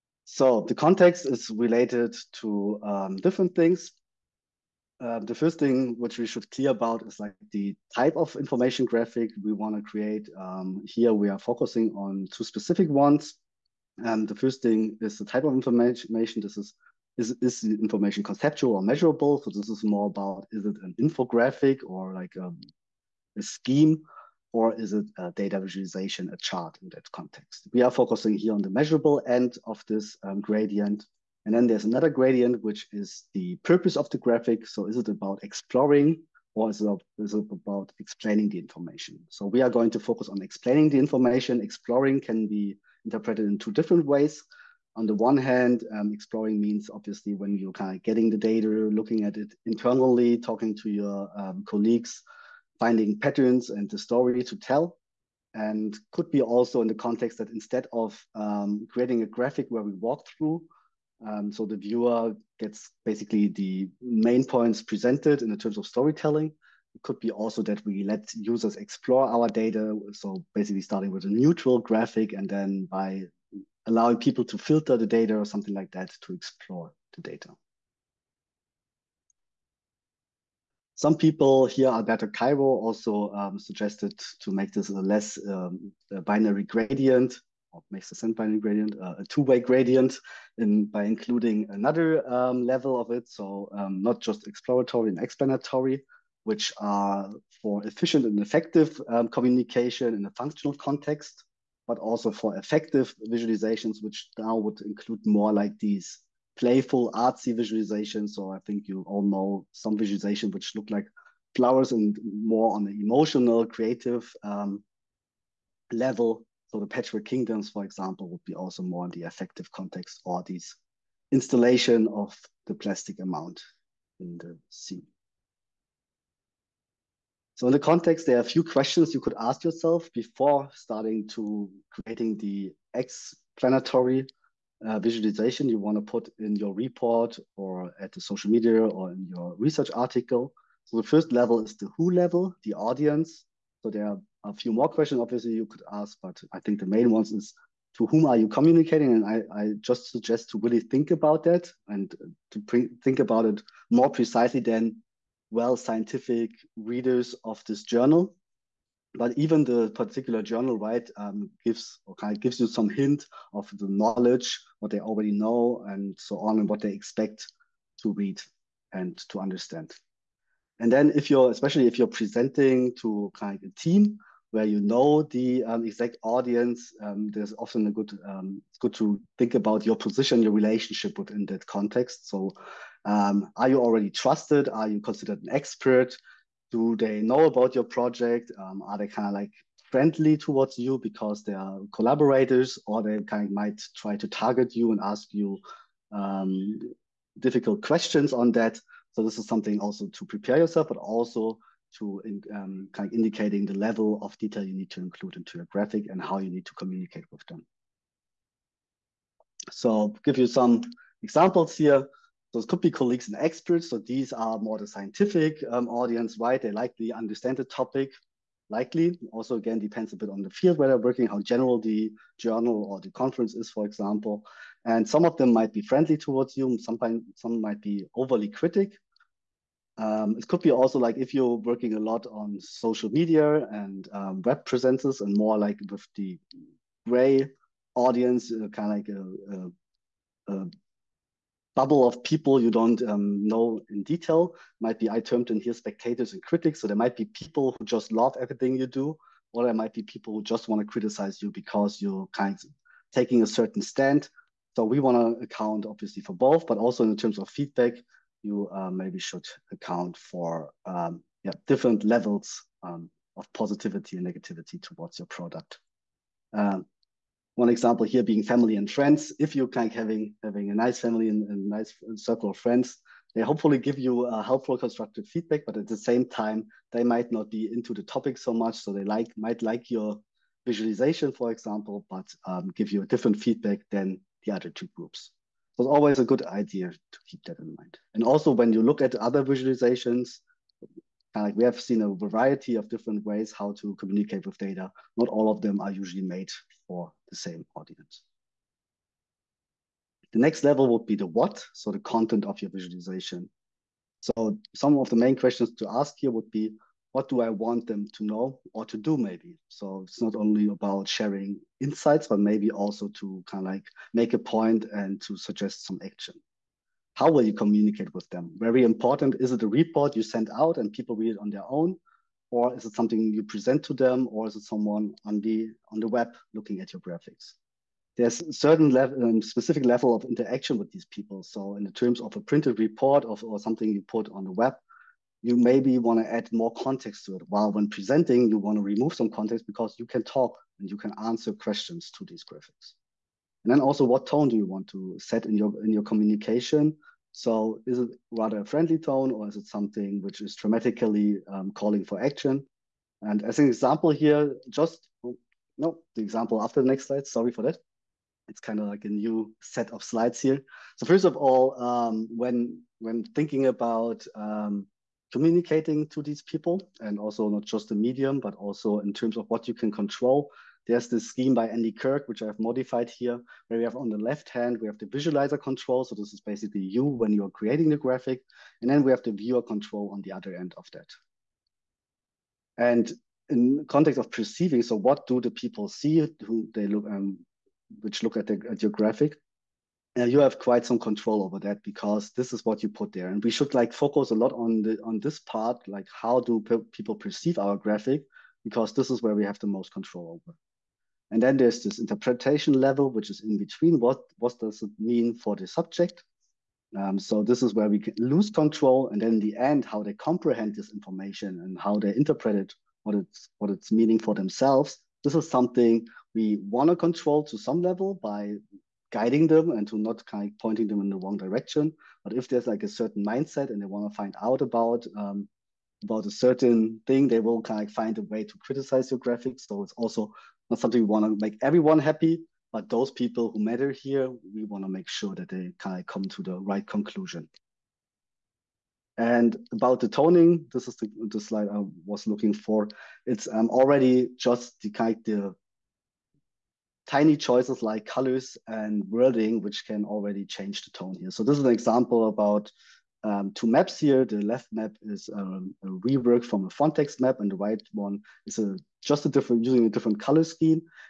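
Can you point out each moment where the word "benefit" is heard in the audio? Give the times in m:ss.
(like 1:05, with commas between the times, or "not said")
not said.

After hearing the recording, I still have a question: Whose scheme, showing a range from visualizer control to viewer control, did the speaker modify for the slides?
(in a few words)
Andy Kirk.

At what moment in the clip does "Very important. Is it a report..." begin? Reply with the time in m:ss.
5:18.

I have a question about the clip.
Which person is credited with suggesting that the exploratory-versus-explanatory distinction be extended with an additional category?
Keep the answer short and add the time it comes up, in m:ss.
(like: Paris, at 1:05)
Alberto Cairo, at 1:21.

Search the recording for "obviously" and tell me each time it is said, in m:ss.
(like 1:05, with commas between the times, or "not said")
0:46, 2:25, 4:15.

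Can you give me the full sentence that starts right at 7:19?
And about the toning, this is the, the slide I was looking for.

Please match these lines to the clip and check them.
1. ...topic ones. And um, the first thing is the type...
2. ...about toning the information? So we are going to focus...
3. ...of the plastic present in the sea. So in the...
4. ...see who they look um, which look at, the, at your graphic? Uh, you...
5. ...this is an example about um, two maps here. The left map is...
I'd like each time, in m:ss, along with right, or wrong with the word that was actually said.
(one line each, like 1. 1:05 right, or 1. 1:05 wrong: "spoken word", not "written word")
1. 0:12 wrong: "specific", not "topic"
2. 0:37 wrong: "explaining", not "toning"
3. 2:02 wrong: "amount", not "present"
4. 6:25 right
5. 7:31 right.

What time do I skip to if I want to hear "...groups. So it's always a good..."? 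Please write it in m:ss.
4:44.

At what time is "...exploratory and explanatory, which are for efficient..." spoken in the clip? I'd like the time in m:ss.
1:34.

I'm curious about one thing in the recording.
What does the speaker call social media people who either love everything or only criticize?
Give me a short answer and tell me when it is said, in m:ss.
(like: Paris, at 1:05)
spectators and critics, at 4:05.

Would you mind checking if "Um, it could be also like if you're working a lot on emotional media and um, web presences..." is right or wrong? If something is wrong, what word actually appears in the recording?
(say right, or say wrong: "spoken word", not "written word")
wrong: "social", not "emotional".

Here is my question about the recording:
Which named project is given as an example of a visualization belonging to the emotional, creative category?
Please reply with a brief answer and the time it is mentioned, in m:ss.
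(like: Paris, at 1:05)
Patchwork Kingdoms, at 1:56.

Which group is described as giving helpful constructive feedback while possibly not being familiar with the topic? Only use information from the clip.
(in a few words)
family and friends.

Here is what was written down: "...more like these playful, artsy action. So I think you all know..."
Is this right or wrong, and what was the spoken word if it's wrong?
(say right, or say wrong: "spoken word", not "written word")
wrong: "visualization", not "action".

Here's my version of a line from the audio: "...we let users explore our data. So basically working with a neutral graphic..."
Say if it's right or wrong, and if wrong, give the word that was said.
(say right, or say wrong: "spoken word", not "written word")
wrong: "starting", not "working".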